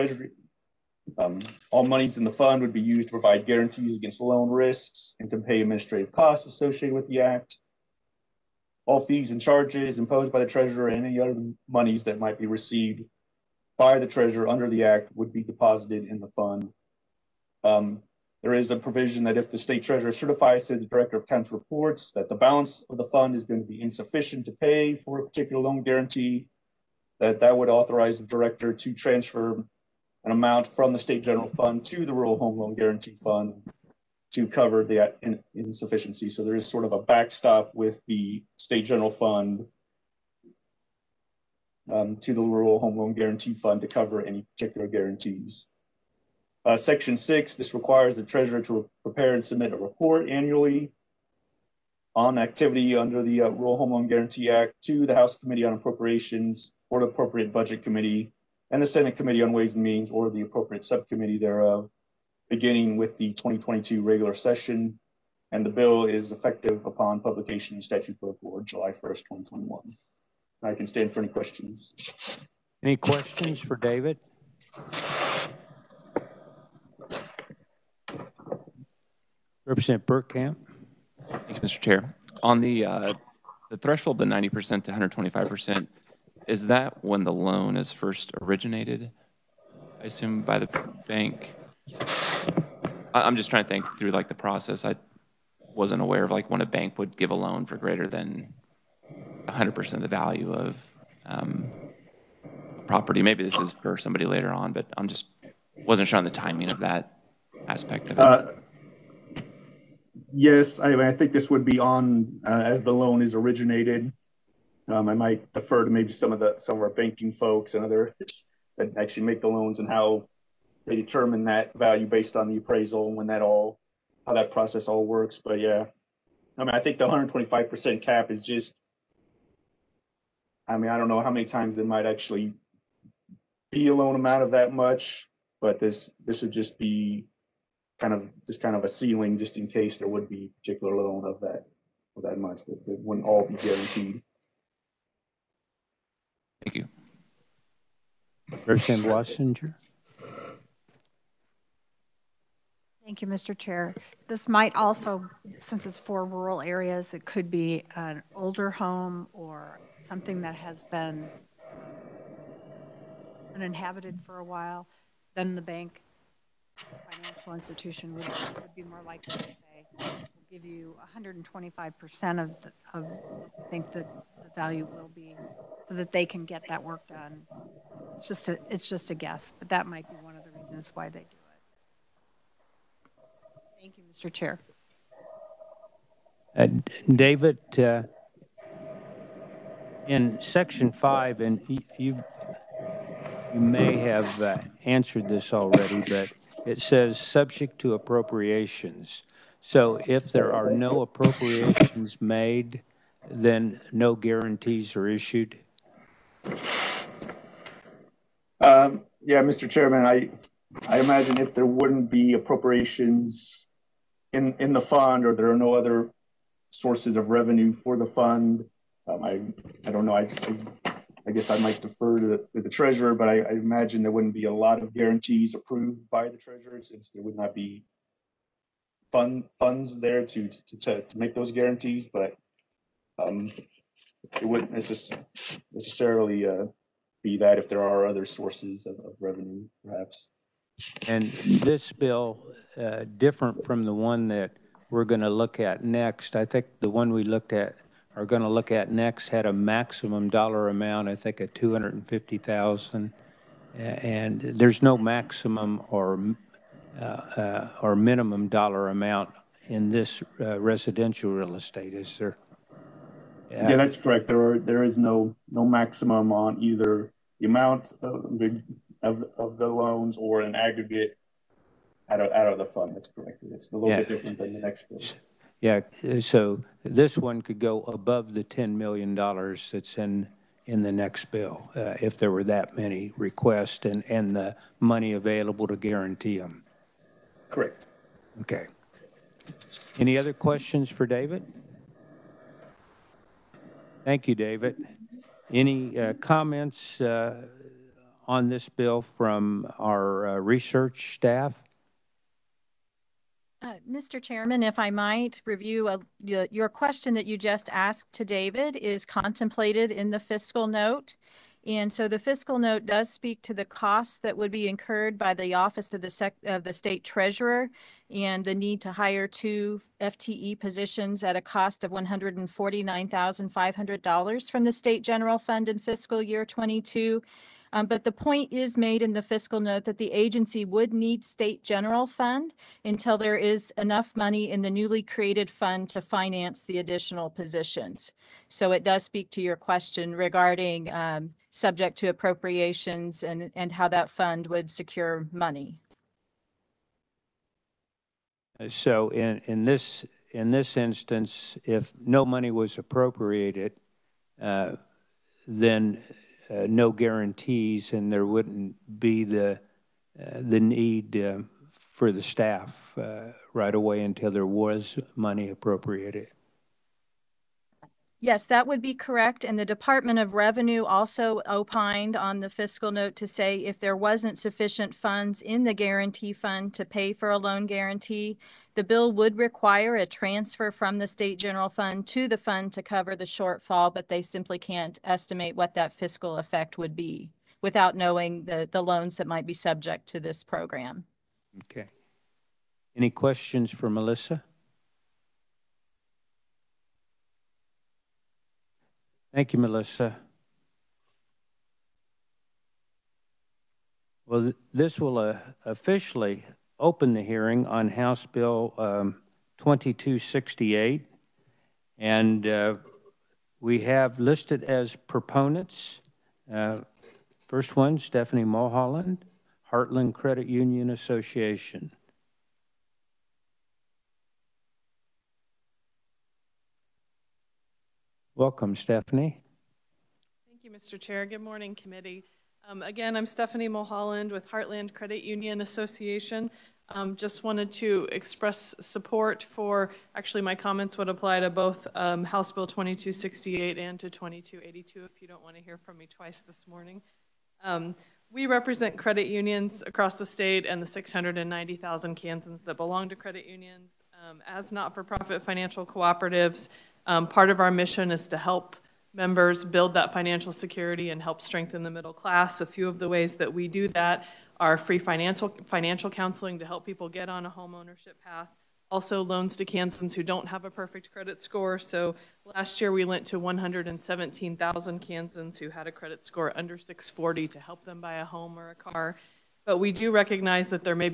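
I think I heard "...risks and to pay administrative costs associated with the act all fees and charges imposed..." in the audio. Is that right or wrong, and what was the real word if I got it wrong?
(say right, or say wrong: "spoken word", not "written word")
right.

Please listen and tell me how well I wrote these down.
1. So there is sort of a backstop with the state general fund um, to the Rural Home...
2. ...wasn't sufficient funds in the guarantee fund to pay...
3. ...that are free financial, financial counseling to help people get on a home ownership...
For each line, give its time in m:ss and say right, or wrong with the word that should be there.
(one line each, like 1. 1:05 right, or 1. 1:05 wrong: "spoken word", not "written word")
1. 0:36 right
2. 6:13 right
3. 7:43 right.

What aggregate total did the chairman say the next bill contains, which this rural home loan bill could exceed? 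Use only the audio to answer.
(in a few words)
10 million dollars.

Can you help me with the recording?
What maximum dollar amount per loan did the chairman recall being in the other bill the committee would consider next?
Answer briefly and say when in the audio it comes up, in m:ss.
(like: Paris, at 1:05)
250,000, at 4:11.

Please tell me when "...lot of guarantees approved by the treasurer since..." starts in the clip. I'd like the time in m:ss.
3:44.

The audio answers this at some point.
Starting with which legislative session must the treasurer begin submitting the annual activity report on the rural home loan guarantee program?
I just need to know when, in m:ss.
1:03.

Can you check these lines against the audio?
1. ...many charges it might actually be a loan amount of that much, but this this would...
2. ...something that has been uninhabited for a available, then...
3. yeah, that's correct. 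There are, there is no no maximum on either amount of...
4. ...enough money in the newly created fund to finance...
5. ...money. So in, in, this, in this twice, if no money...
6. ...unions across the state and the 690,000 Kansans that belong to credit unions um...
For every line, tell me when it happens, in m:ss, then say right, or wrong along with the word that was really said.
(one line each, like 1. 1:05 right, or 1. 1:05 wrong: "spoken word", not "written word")
1. 2:11 wrong: "times", not "charges"
2. 2:40 wrong: "while", not "available"
3. 4:23 right
4. 5:33 right
5. 5:45 wrong: "instance", not "twice"
6. 7:29 right.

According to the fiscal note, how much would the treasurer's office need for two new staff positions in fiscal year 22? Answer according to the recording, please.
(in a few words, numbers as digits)
$149,500.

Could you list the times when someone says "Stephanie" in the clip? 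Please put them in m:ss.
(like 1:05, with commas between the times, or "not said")
6:57, 7:08, 7:13.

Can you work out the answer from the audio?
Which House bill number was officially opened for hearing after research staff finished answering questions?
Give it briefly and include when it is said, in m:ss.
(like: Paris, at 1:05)
House Bill 2268, at 6:47.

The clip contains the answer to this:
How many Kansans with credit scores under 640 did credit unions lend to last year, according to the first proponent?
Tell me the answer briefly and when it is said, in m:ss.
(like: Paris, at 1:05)
117,000, at 7:53.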